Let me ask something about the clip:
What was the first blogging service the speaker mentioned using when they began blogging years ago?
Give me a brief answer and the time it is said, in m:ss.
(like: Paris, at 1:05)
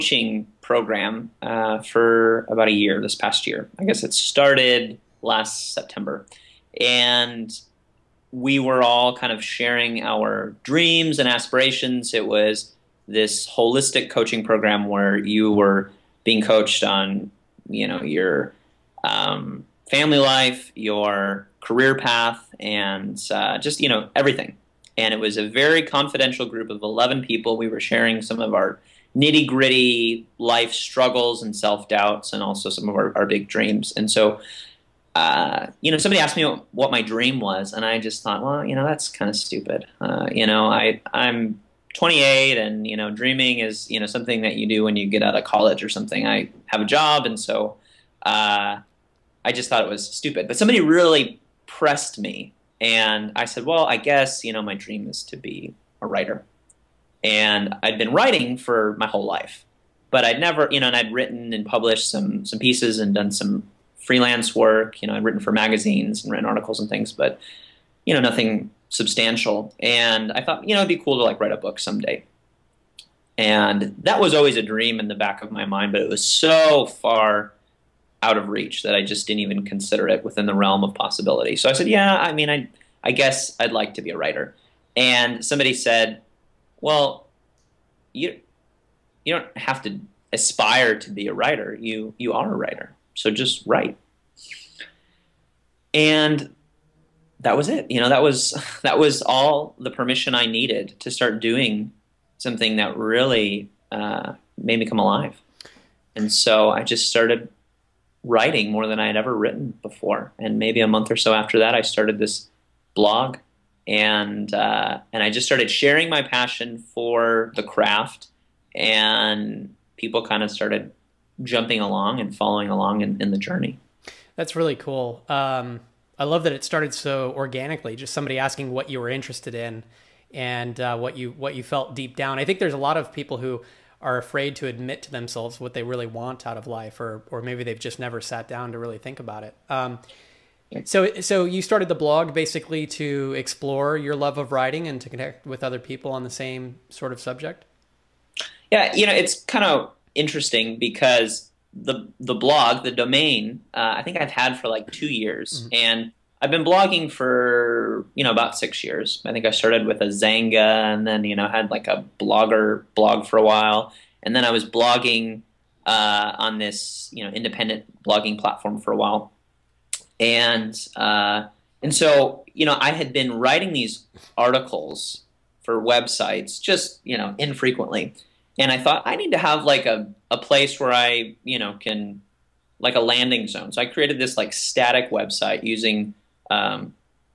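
Xanga, at 2:40.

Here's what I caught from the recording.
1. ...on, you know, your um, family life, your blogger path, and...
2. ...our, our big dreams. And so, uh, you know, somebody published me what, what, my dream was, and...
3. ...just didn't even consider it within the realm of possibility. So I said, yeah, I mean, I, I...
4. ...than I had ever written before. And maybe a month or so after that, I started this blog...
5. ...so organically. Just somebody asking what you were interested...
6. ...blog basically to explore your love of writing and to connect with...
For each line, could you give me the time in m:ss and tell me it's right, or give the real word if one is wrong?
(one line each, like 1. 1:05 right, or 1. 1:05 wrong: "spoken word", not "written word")
1. 0:16 wrong: "career", not "blogger"
2. 0:32 wrong: "asked", not "published"
3. 1:19 right
4. 1:48 right
5. 2:06 right
6. 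2:21 right.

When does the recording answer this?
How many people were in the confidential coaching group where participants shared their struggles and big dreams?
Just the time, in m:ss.
0:26.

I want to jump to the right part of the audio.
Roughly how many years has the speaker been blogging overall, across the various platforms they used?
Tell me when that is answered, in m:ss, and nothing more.
2:38.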